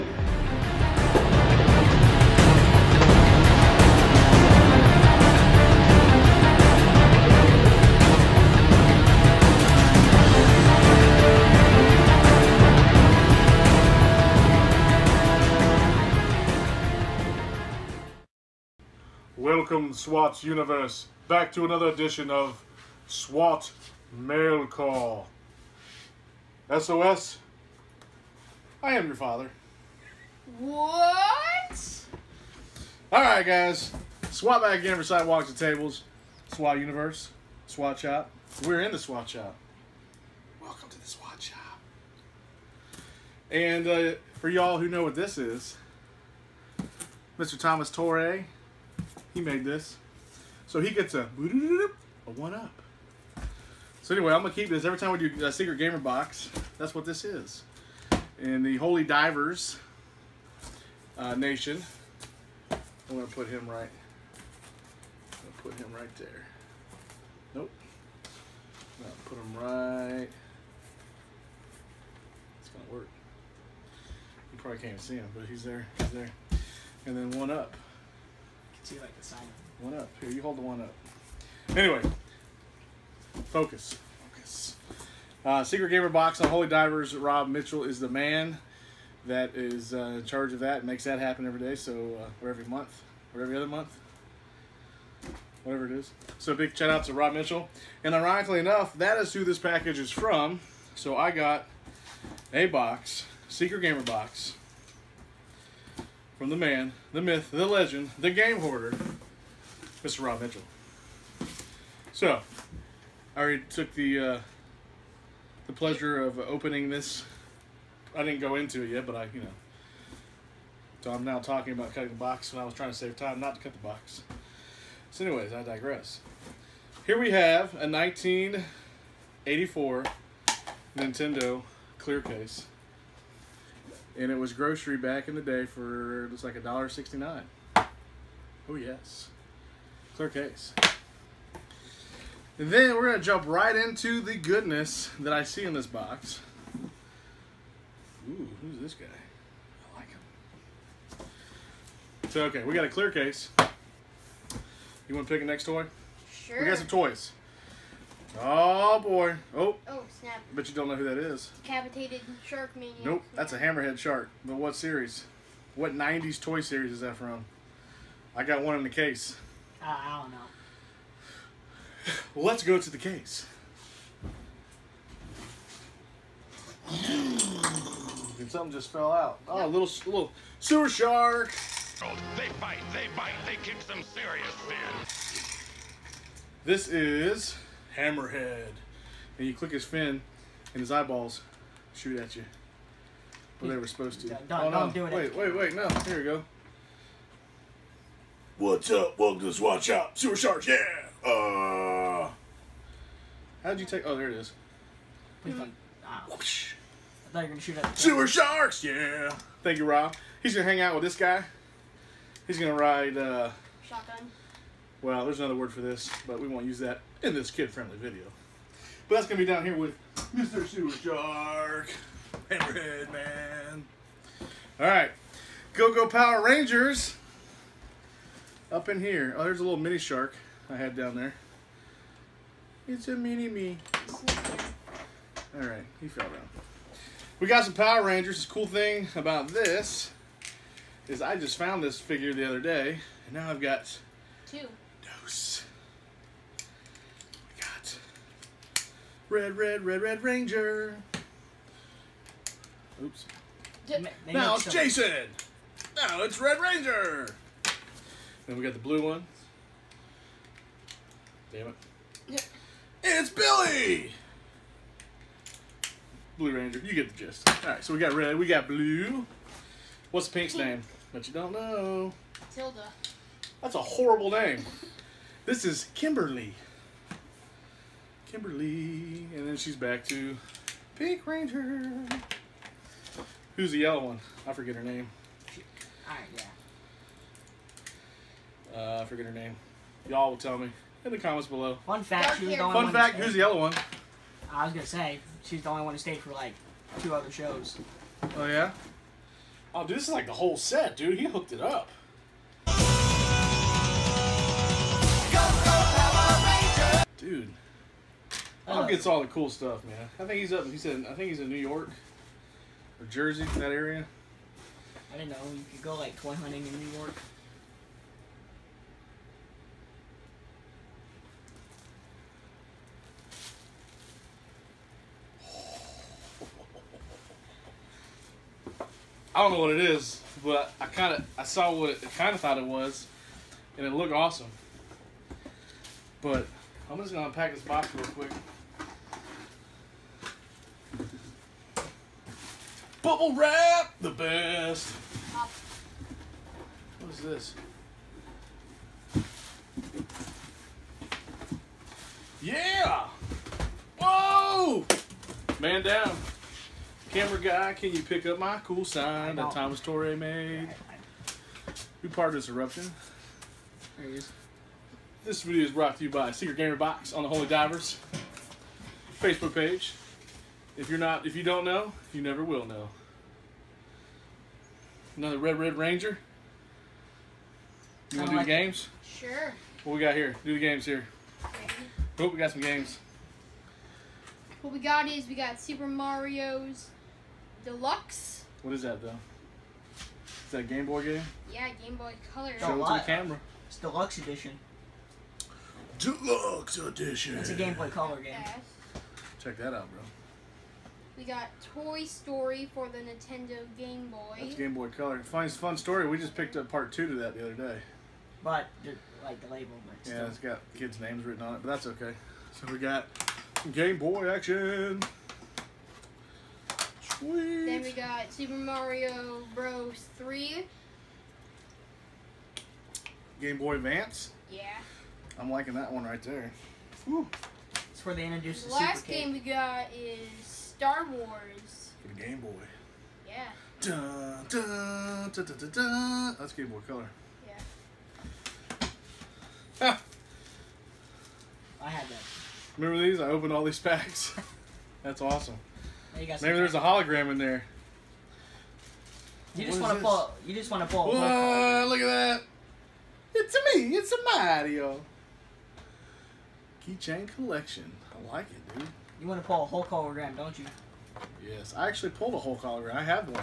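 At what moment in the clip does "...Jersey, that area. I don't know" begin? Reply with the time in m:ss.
5:13.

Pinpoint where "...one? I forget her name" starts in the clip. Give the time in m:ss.
4:44.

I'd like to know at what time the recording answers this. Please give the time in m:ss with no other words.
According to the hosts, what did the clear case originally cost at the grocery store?
2:16.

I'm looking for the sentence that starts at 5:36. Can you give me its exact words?
But I'm just gonna unpack this box real quick.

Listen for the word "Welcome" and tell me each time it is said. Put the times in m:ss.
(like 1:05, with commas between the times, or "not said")
0:19, 0:40, 3:19.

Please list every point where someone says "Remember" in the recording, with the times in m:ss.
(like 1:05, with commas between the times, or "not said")
7:22.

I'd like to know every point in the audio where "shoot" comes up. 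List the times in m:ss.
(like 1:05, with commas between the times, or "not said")
3:11, 3:27.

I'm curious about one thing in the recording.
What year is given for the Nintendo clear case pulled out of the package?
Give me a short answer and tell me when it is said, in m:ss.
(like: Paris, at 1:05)
1984, at 2:07.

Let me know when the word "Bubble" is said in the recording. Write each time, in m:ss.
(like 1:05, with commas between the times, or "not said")
5:43.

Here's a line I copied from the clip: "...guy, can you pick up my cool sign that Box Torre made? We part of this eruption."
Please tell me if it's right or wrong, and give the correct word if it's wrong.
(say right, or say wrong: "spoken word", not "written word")
wrong: "Thomas", not "Box".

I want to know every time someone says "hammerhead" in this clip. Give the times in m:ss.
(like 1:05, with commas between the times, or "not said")
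2:43, 3:07.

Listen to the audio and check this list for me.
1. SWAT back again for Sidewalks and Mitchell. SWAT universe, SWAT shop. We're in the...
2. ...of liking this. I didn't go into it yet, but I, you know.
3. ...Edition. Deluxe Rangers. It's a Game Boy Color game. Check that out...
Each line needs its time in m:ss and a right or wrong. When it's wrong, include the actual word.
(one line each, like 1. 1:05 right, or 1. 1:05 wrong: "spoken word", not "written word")
1. 0:34 wrong: "Tables", not "Mitchell"
2. 1:56 wrong: "opening", not "liking"
3. 6:34 wrong: "Edition", not "Rangers".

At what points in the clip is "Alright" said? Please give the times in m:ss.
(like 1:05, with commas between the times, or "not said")
0:33, 4:46.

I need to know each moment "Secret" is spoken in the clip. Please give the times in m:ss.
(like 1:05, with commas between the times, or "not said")
0:55, 1:25, 1:43, 6:06.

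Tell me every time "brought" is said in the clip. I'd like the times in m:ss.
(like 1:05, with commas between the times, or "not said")
6:05.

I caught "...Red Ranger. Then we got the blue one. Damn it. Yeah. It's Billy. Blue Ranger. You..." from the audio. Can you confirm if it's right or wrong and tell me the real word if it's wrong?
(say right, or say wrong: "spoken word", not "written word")
right.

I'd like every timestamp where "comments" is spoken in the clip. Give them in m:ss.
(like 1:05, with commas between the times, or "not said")
4:51.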